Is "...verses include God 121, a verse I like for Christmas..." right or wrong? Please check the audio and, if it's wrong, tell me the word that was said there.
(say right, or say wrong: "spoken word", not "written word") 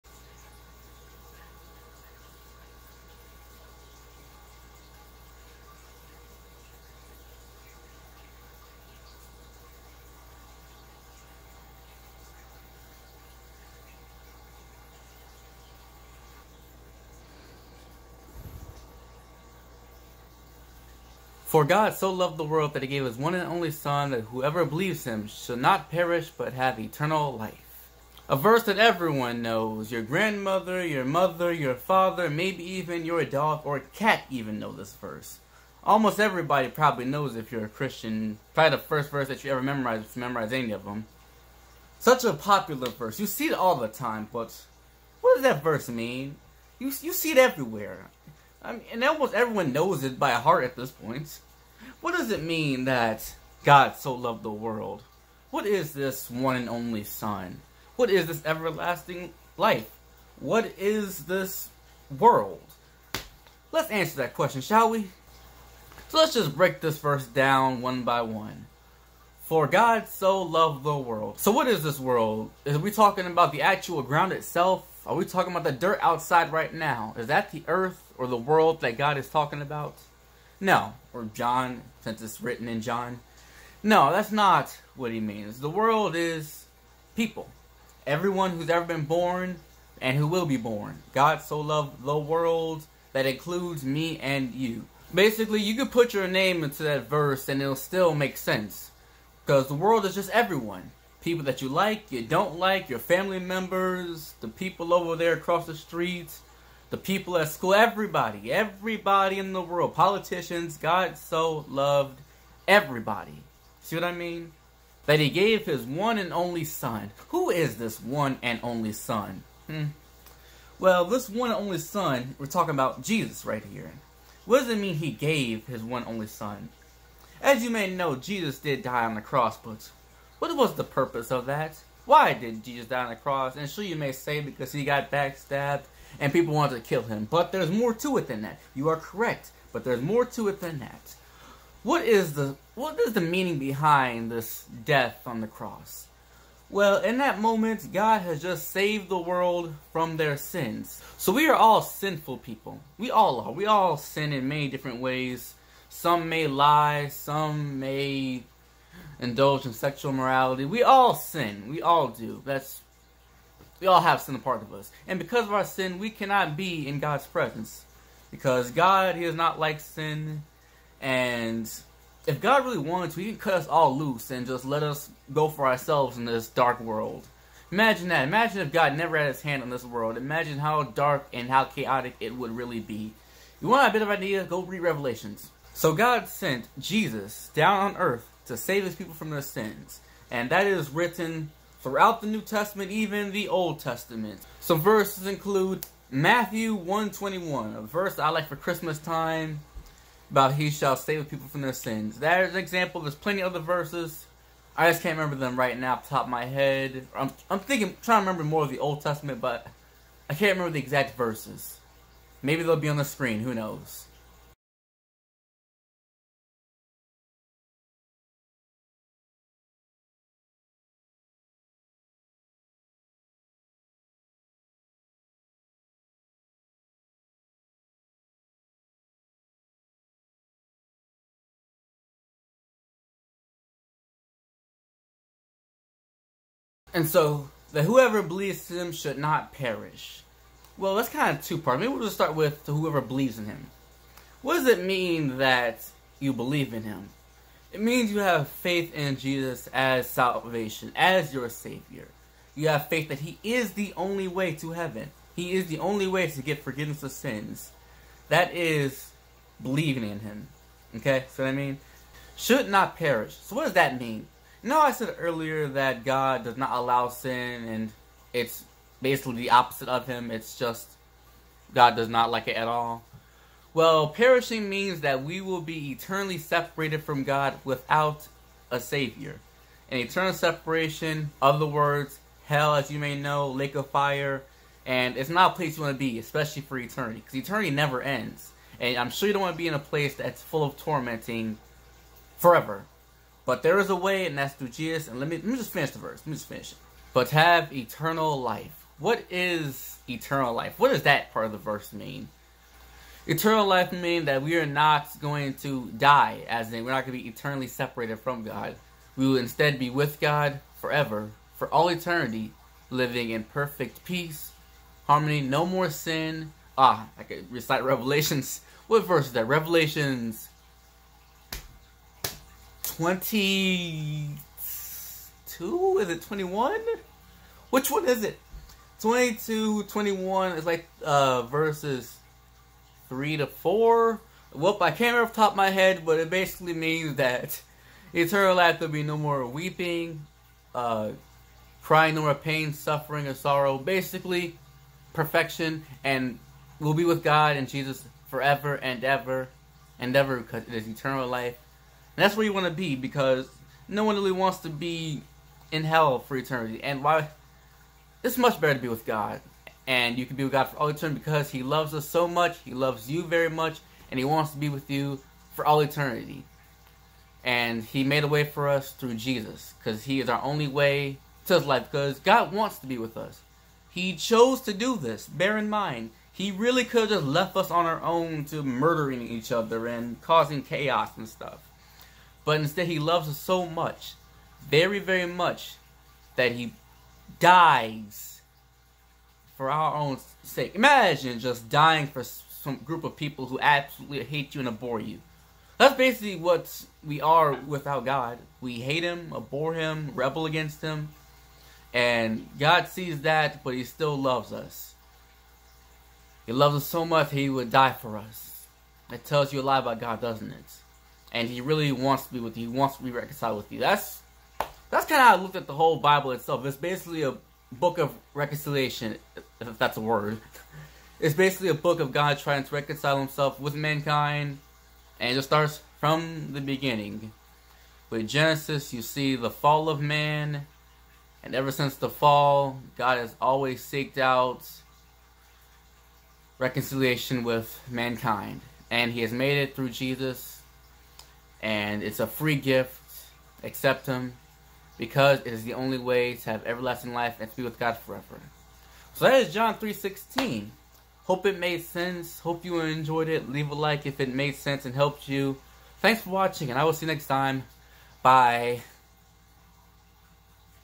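wrong: "Matthew", not "God".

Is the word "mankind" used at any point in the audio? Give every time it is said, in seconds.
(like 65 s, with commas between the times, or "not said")
423 s, 437 s.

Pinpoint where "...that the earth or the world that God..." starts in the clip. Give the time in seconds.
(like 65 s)
77 s.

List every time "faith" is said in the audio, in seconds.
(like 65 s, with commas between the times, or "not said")
248 s, 252 s.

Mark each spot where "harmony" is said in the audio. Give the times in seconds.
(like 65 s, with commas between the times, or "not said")
315 s.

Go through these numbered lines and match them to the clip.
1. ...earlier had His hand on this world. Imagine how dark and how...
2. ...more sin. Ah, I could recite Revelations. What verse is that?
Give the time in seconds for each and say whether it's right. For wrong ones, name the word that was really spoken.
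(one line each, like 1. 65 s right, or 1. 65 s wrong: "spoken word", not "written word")
1. 178 s wrong: "never", not "earlier"
2. 315 s right.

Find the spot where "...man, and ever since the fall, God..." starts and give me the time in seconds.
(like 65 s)
430 s.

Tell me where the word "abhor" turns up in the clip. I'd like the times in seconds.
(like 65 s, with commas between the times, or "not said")
394 s, 399 s.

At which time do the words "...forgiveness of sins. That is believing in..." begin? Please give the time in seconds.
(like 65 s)
256 s.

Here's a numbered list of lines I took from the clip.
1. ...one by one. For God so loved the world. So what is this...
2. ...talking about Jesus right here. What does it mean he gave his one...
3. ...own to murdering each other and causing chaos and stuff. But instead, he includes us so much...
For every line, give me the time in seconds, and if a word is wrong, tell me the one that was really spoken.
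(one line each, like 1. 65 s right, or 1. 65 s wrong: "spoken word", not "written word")
1. 67 s right
2. 122 s right
3. 378 s wrong: "loves", not "includes".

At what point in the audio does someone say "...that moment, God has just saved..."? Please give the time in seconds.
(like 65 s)
147 s.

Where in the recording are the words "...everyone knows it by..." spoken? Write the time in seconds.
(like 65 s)
49 s.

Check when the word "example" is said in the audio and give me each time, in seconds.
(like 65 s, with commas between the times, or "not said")
202 s.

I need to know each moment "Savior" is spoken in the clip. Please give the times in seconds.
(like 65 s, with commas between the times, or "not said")
251 s, 278 s.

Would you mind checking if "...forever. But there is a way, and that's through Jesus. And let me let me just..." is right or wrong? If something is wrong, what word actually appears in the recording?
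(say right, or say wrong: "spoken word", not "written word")
right.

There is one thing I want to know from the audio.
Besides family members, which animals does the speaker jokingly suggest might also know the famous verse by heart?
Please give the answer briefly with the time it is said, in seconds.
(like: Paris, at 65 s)
Dog or cat, at 33 s.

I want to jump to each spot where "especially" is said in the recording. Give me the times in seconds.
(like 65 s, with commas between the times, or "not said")
286 s.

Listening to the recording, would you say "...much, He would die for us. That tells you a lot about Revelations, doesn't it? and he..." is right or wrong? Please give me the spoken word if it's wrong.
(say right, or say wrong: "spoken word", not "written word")
wrong: "God", not "Revelations".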